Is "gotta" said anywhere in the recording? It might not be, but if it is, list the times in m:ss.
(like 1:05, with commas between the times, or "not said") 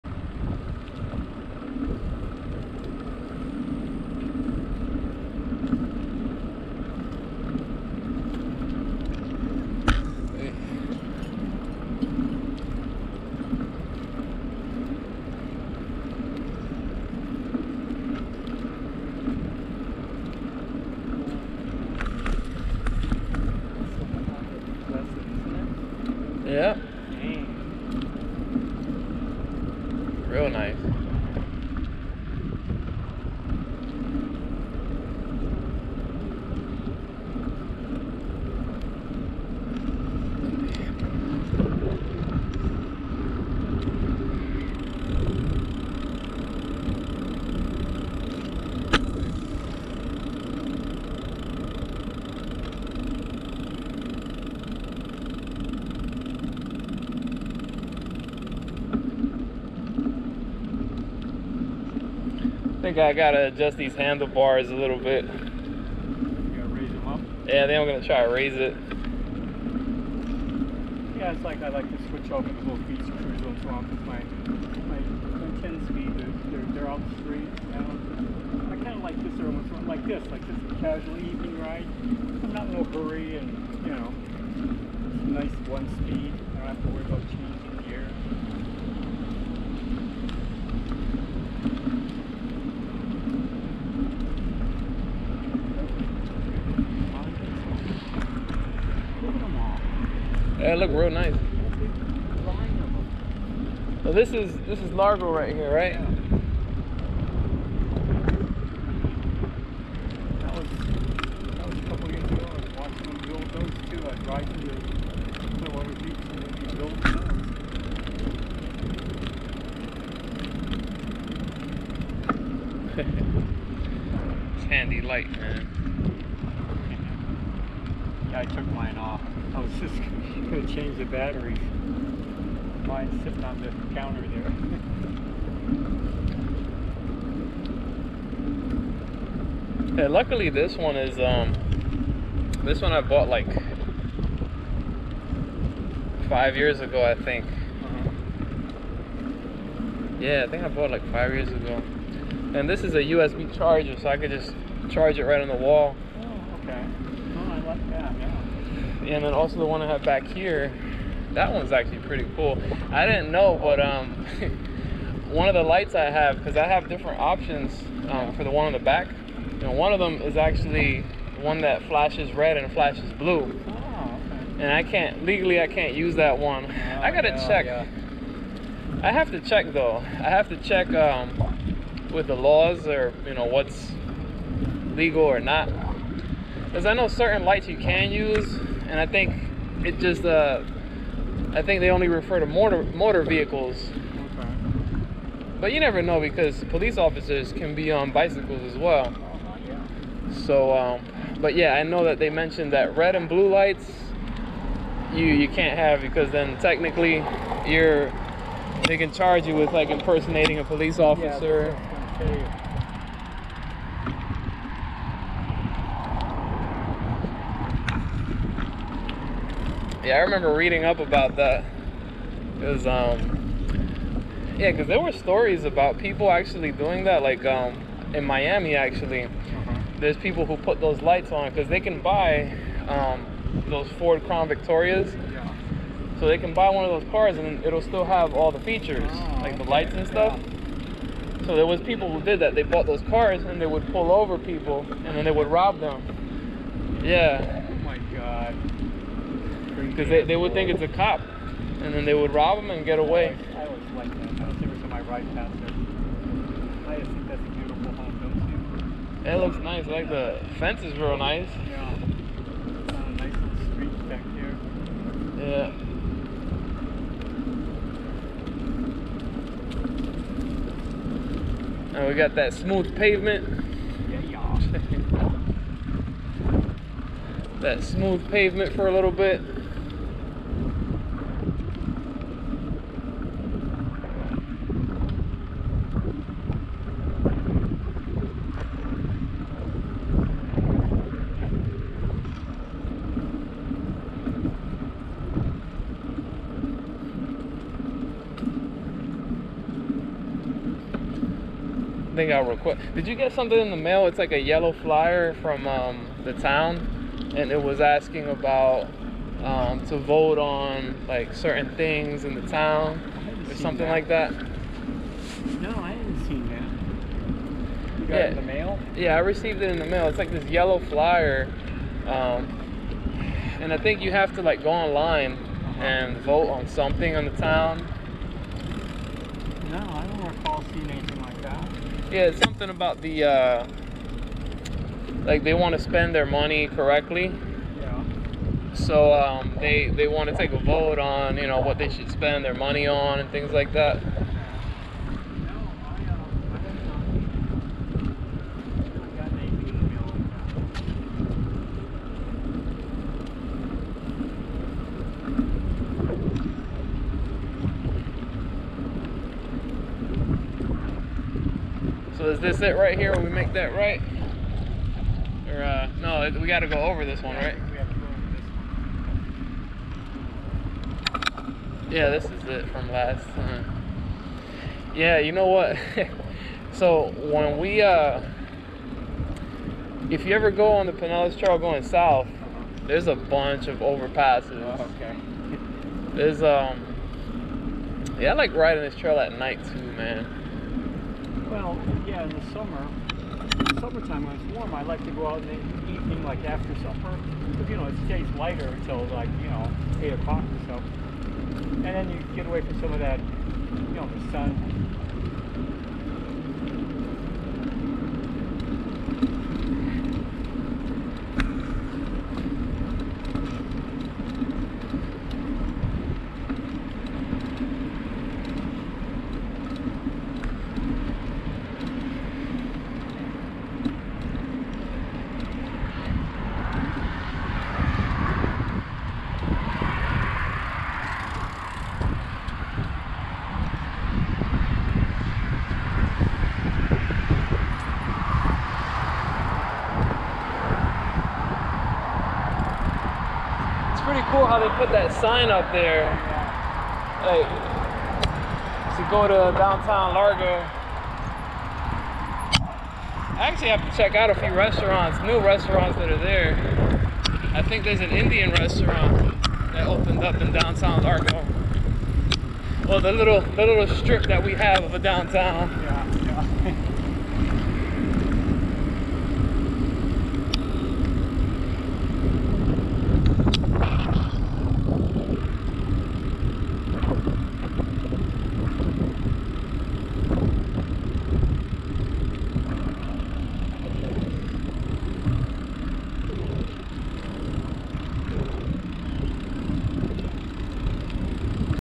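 1:03, 2:57.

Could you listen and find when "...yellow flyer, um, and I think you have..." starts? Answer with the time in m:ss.
5:20.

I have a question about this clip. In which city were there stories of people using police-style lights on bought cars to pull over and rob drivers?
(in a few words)
Miami.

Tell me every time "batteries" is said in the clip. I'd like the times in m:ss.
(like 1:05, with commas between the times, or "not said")
2:11.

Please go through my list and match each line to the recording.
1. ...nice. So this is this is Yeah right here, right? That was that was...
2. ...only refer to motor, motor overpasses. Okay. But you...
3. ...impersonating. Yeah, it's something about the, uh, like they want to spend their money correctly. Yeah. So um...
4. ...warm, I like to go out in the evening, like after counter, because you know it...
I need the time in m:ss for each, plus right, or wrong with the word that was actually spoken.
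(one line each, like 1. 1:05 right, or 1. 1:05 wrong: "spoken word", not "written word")
1. 1:41 wrong: "Largo", not "Yeah"
2. 3:11 wrong: "vehicles", not "overpasses"
3. 5:30 wrong: "anything", not "impersonating"
4. 6:34 wrong: "supper", not "counter".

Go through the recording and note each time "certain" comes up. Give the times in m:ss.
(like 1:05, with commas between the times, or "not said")
3:07, 5:11.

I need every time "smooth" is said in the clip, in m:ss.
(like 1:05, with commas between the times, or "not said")
4:32, 4:37.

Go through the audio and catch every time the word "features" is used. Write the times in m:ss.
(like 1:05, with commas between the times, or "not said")
3:58.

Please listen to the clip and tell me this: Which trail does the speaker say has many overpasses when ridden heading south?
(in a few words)
Pinellas Trail.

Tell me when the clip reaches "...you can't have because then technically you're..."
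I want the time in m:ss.
3:25.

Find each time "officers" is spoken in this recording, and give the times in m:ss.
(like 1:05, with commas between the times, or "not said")
3:16, 3:30.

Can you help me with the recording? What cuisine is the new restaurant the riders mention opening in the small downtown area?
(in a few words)
Indian.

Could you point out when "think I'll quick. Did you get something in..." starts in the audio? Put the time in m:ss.
5:02.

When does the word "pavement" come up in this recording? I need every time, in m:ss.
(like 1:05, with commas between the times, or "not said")
4:32, 4:38.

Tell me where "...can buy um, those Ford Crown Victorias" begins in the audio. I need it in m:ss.
3:51.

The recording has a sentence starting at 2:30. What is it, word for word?
Yeah, I think I bought like five years ago.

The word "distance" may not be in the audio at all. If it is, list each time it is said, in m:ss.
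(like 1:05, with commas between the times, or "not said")
not said.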